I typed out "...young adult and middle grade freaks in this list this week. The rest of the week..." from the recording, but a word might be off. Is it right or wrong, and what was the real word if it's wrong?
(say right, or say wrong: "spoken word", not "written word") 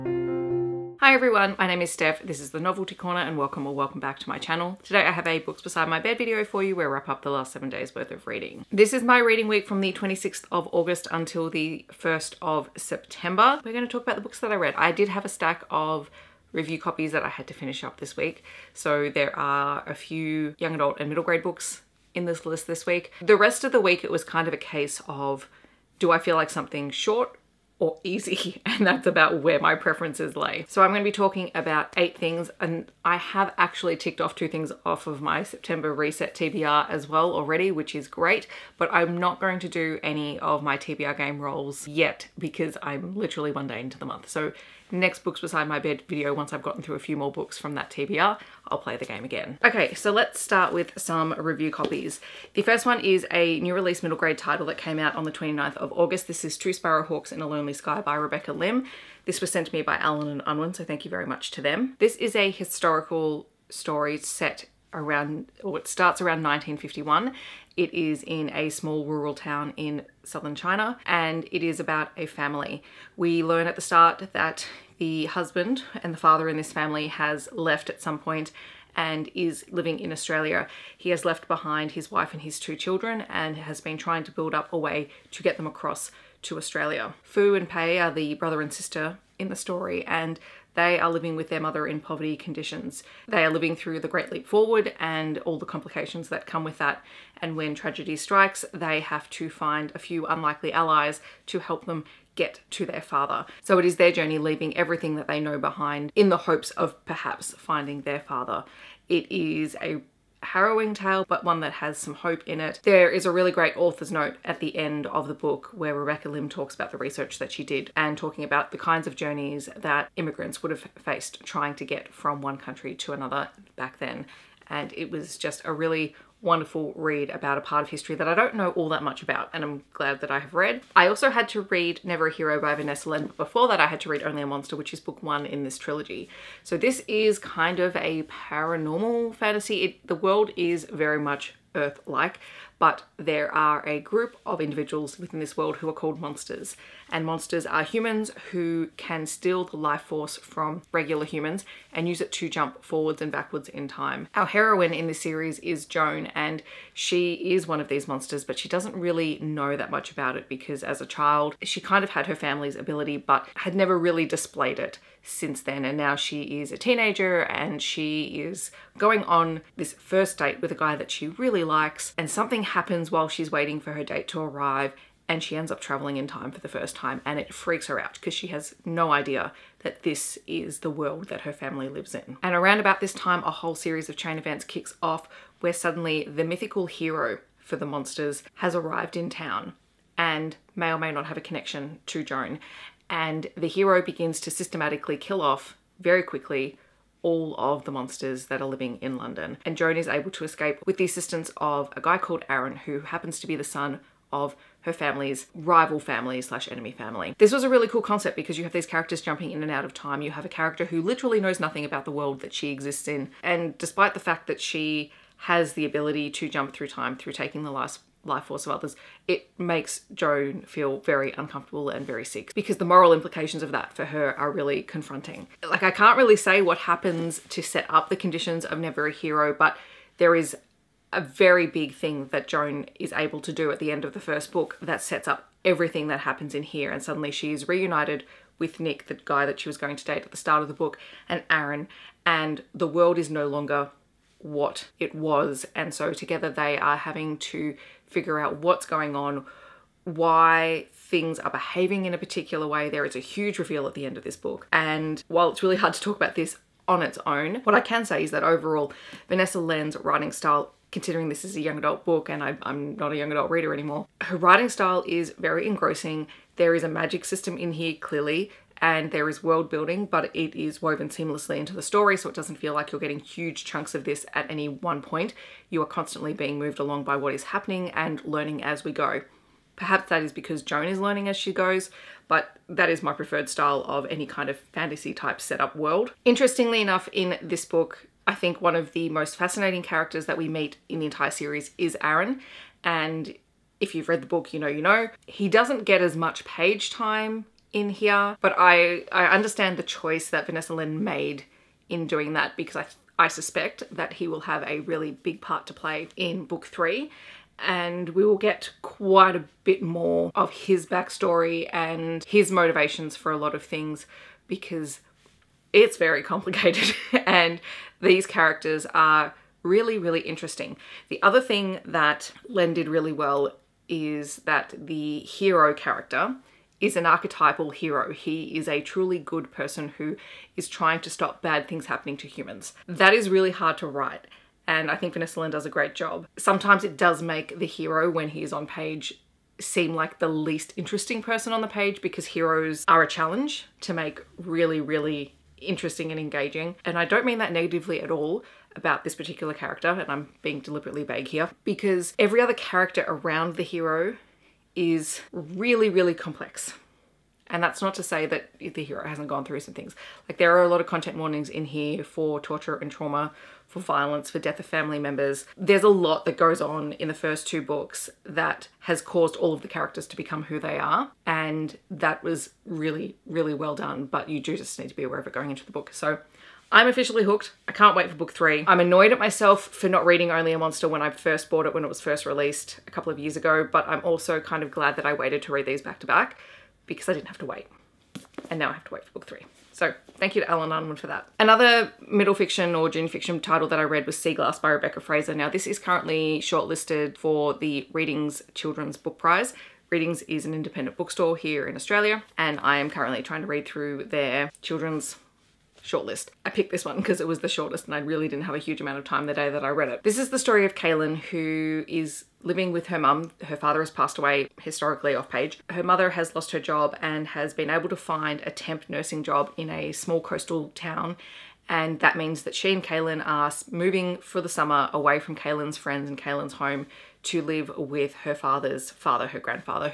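wrong: "books", not "freaks".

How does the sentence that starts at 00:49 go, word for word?
Okay so let's start with some review copies.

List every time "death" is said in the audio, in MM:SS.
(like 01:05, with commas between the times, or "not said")
06:04.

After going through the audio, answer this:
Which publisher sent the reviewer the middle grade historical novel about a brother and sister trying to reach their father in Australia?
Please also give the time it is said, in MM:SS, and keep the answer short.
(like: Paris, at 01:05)
Allen and Unwin, at 00:59.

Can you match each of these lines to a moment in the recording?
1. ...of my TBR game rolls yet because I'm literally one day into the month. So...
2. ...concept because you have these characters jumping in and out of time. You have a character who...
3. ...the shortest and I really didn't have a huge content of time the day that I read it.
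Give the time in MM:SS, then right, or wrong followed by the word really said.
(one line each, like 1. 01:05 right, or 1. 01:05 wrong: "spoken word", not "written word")
1. 00:40 right
2. 03:28 right
3. 06:47 wrong: "amount", not "content".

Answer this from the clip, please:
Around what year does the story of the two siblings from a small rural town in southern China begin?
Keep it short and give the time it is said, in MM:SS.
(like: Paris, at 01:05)
1951, at 01:06.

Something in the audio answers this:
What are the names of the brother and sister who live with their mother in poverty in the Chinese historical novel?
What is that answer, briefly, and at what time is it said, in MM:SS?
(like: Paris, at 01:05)
Fu and Pei, at 01:27.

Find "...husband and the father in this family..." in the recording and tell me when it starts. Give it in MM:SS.
01:15.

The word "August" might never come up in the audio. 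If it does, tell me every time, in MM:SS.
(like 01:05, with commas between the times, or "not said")
00:10, 00:55.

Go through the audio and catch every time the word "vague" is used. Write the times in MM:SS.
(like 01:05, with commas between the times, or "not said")
05:51.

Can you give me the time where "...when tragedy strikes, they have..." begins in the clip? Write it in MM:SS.
01:37.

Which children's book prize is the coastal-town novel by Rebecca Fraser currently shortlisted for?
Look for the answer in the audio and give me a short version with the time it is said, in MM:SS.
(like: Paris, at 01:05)
Readings Children's Book Prize, at 06:37.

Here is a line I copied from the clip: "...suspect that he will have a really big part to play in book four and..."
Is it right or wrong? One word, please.
wrong.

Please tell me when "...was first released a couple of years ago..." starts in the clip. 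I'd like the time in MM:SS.
06:21.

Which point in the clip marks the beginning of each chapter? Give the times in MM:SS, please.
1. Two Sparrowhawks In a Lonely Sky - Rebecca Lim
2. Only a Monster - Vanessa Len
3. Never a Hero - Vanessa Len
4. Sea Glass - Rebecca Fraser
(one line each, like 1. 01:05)
1. 00:51
2. 02:10
3. 03:50
4. 06:30.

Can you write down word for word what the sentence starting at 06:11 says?
And that was really, really well done, but you do just need to be aware of it going into the book.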